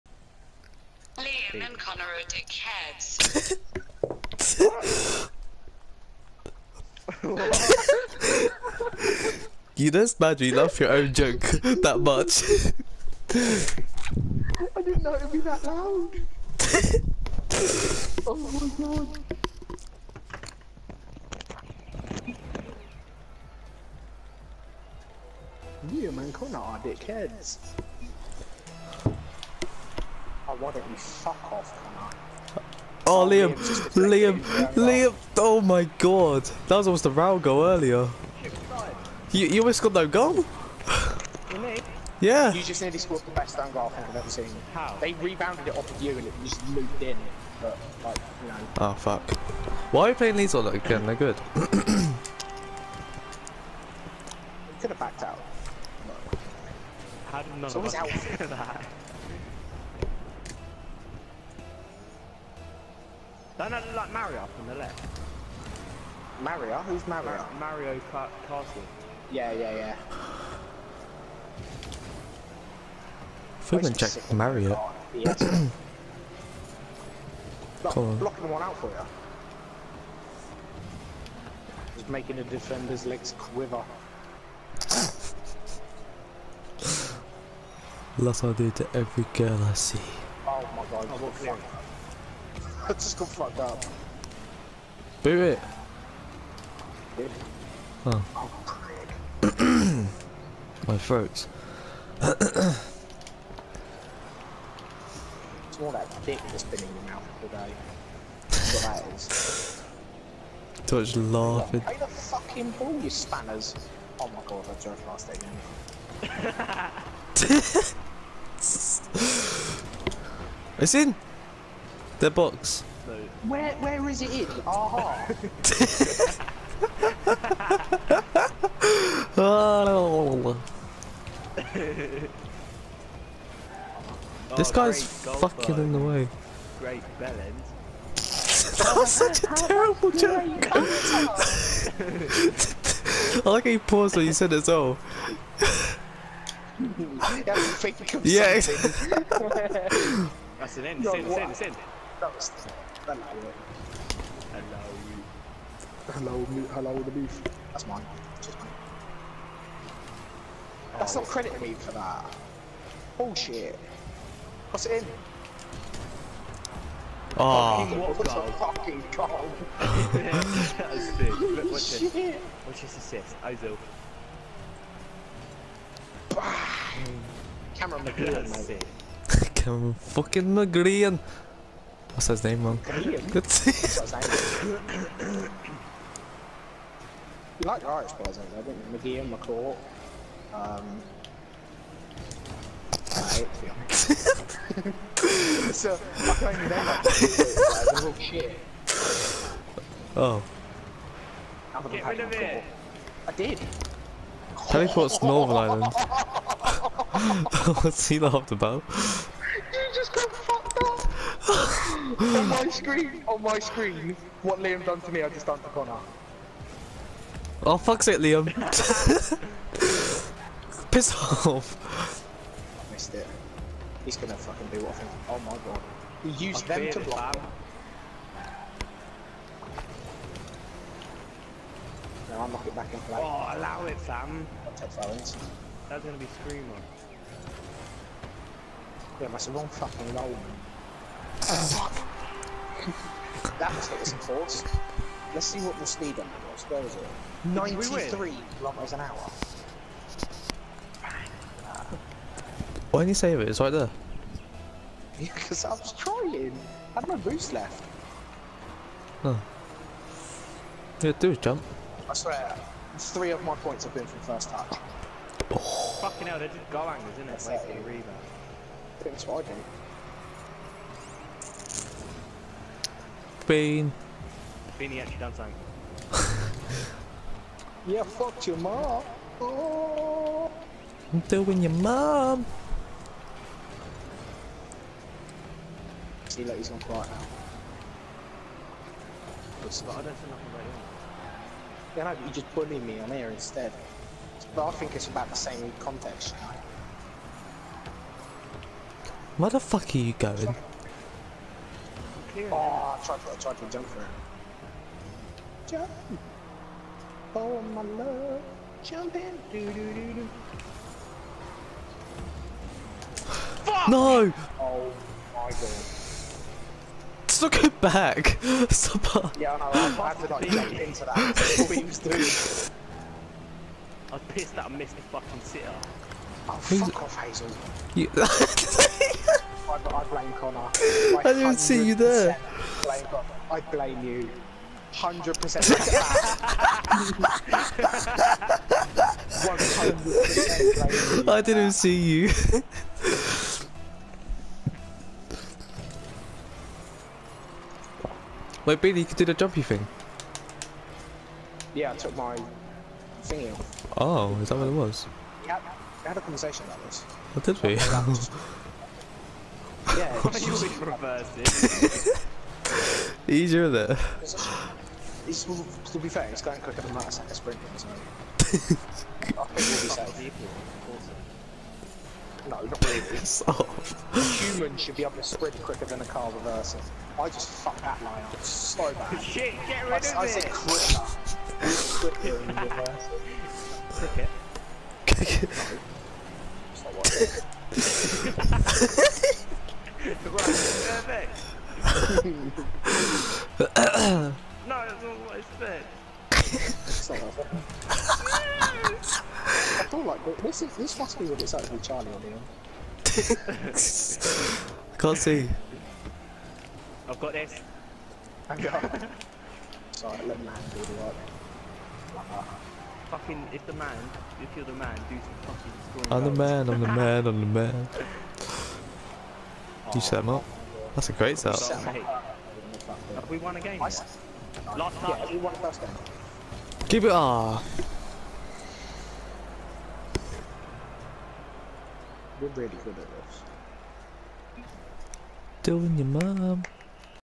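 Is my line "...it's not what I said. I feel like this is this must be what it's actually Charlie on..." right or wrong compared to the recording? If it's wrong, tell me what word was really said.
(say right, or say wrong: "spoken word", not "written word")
right.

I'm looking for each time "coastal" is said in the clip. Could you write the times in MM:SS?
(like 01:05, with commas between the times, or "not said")
not said.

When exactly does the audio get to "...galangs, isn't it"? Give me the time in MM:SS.
04:26.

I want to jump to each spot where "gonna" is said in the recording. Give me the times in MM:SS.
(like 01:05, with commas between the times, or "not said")
03:44, 03:54.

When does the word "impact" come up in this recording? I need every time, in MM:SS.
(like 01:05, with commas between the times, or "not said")
not said.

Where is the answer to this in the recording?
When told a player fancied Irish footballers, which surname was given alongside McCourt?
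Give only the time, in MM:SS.
03:08.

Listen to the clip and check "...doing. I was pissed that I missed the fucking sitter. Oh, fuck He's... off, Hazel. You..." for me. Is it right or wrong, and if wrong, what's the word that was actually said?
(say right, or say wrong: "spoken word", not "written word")
right.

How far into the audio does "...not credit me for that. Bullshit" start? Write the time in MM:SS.
02:41.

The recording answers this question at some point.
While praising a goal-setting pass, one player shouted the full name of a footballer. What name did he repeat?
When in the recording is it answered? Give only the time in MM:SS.
02:57.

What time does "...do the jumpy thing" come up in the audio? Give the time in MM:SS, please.
05:49.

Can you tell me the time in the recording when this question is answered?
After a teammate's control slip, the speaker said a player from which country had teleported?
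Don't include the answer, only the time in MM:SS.
03:25.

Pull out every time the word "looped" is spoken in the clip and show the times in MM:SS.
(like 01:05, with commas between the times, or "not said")
00:46.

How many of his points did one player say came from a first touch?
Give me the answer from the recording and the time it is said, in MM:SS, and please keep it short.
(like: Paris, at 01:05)
3, at 04:22.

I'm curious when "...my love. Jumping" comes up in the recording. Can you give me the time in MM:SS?
05:07.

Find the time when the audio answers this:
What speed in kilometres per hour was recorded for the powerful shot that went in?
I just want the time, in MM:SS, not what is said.
04:07.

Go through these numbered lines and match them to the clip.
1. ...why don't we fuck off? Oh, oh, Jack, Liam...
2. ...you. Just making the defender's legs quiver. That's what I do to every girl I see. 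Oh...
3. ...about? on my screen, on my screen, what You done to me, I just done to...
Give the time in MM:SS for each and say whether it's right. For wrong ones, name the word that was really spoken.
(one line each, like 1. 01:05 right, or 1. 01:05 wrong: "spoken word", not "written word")
1. 00:30 wrong: "Liam", not "Jack"
2. 01:18 right
3. 03:28 wrong: "Liam", not "You".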